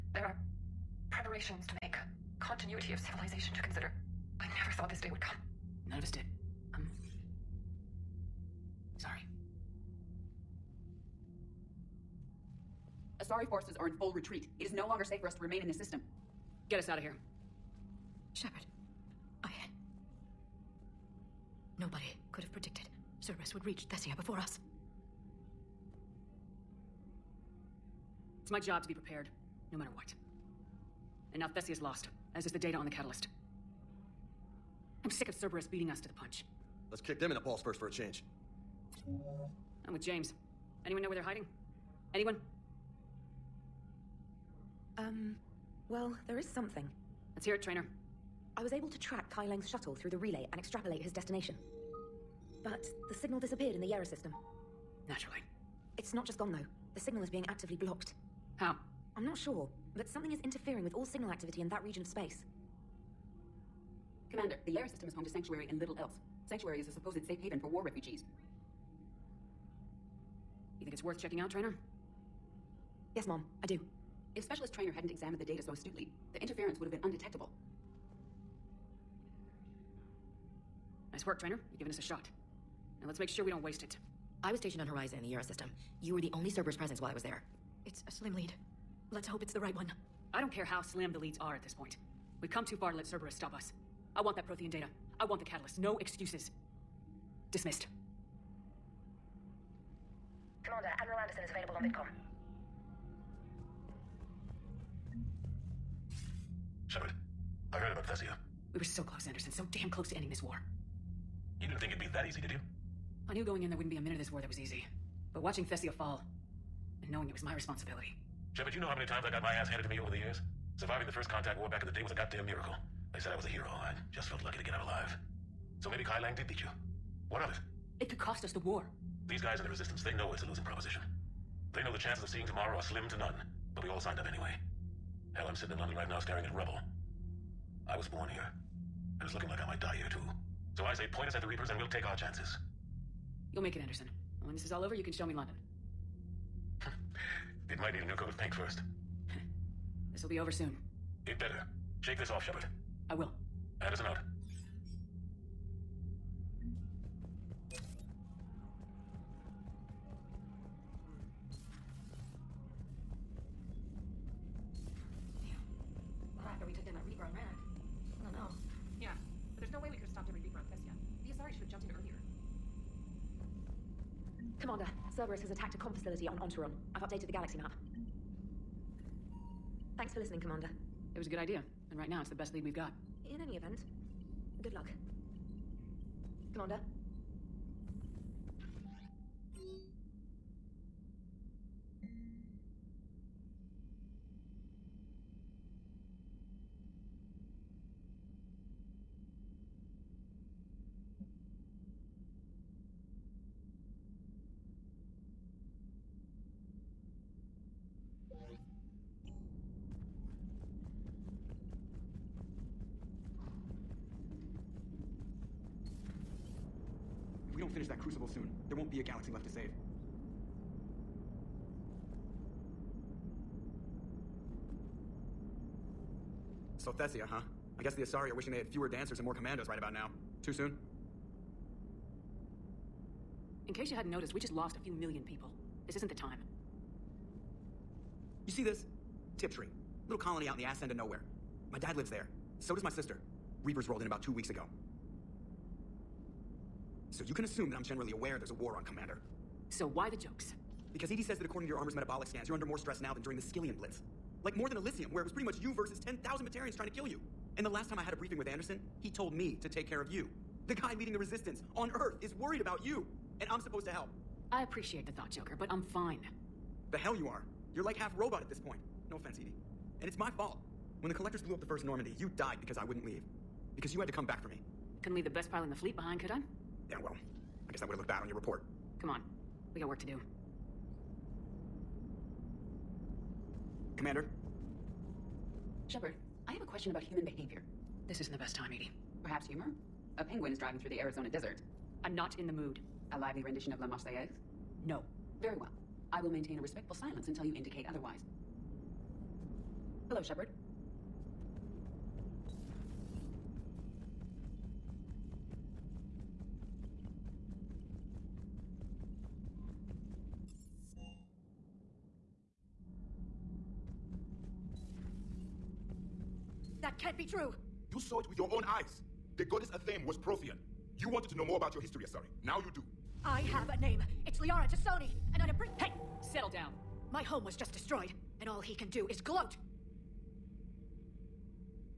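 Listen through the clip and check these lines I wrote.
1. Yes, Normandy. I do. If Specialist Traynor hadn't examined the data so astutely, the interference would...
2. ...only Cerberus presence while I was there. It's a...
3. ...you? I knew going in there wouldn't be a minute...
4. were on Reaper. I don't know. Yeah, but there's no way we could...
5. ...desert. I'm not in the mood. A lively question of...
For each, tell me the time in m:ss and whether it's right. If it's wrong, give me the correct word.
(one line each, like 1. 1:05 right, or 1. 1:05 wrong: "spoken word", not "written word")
1. 1:13 wrong: "Mom", not "Normandy"
2. 1:26 right
3. 1:52 right
4. 2:47 wrong: "Rannoch", not "Reaper"
5. 4:51 wrong: "rendition", not "question".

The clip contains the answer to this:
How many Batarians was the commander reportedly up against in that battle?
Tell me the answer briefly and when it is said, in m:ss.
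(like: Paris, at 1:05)
10,000, at 4:15.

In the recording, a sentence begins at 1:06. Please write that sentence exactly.
Sanctuary is a supposed safe haven for war refugees.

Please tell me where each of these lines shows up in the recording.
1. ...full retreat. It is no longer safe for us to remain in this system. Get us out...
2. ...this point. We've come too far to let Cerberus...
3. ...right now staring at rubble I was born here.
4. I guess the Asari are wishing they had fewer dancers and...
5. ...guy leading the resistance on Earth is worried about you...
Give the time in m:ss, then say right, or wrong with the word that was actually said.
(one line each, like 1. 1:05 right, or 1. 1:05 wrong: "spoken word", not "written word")
1. 0:13 right
2. 1:31 right
3. 2:15 right
4. 3:47 right
5. 4:20 right.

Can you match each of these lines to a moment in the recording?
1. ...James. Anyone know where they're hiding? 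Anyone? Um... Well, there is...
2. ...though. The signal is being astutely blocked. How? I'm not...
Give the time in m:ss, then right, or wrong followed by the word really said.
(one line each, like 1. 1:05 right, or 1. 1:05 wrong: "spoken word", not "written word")
1. 0:40 right
2. 0:56 wrong: "actively", not "astutely".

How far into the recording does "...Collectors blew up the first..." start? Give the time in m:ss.
4:31.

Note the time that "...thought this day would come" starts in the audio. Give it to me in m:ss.
0:04.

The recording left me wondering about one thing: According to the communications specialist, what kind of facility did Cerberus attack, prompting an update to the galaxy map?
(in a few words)
comm facility.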